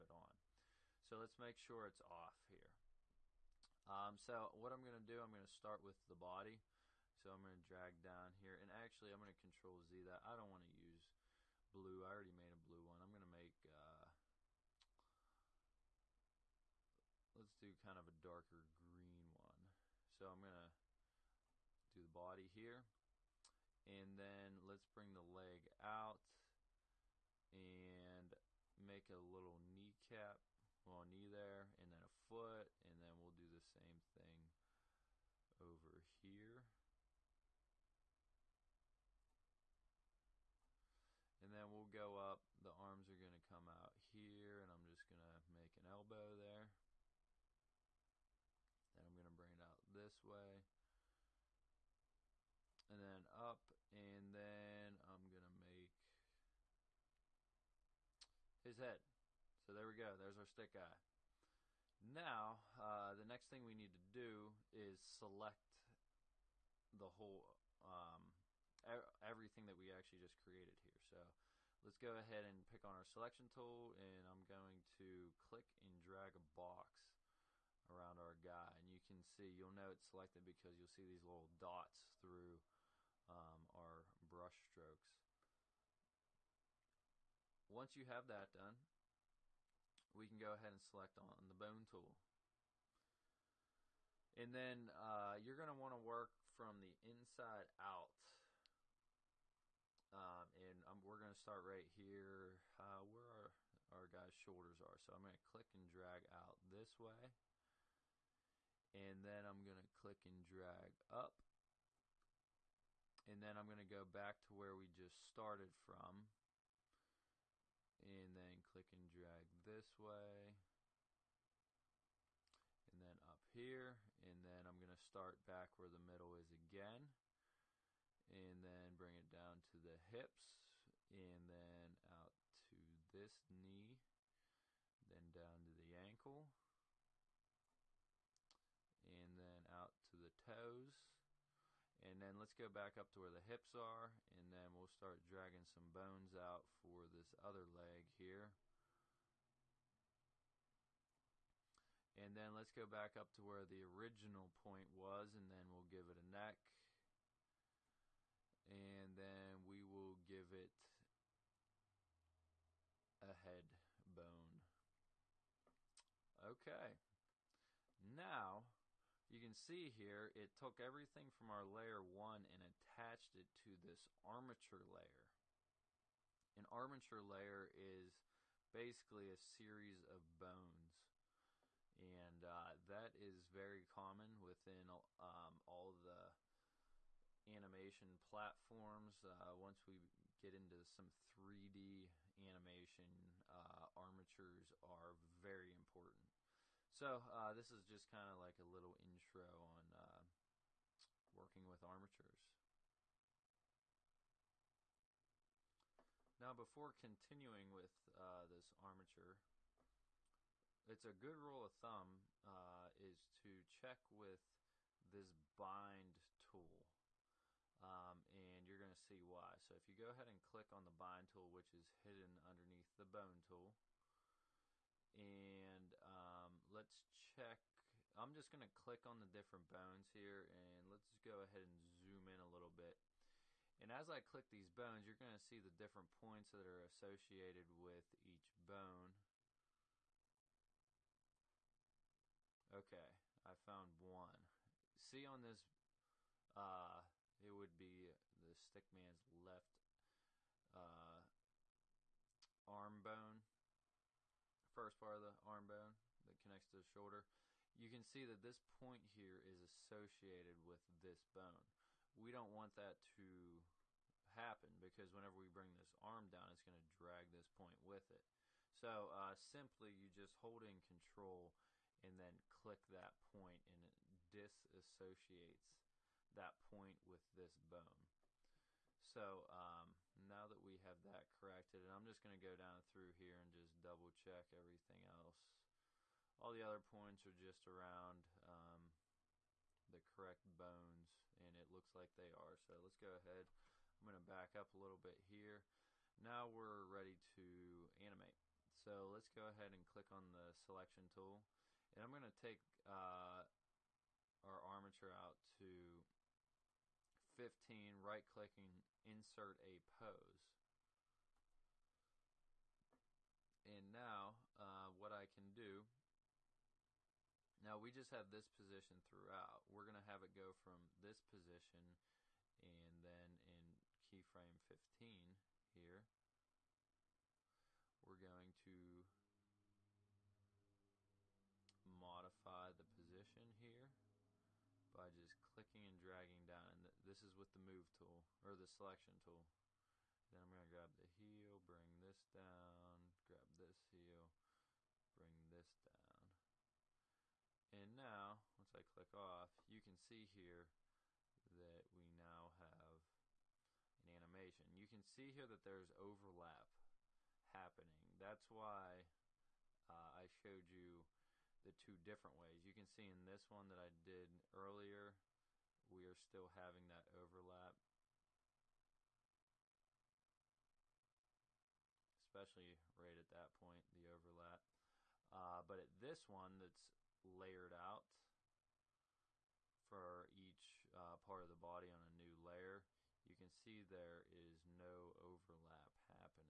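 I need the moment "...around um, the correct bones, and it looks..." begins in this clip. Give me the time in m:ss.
4:47.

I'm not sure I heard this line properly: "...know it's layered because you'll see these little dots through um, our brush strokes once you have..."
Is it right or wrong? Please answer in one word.
wrong.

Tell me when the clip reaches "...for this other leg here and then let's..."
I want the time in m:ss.
2:26.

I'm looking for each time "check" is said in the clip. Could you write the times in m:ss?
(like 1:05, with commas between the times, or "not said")
3:33, 3:47, 4:44.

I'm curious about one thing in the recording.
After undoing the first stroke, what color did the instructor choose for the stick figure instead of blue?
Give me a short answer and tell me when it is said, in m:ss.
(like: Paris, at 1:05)
darker green, at 0:18.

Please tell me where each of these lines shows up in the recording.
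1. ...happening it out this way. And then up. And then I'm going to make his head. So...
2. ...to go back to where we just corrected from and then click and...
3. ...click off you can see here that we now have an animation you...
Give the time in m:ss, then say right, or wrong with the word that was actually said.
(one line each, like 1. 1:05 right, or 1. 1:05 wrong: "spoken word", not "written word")
1. 0:49 wrong: "bring", not "happening"
2. 1:53 wrong: "started", not "corrected"
3. 5:48 right.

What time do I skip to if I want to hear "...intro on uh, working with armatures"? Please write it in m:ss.
3:18.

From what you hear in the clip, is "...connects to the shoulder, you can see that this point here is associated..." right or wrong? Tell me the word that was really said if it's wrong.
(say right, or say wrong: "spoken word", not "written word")
right.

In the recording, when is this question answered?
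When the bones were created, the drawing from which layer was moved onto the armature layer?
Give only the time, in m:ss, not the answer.
2:51.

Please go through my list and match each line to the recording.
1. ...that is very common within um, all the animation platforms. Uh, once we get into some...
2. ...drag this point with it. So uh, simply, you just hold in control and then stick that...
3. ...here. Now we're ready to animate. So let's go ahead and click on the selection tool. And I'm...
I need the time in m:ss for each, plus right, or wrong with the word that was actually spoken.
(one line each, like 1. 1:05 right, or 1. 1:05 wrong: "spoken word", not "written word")
1. 3:02 right
2. 4:26 wrong: "click", not "stick"
3. 4:55 right.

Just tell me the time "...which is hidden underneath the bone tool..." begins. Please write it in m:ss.
3:41.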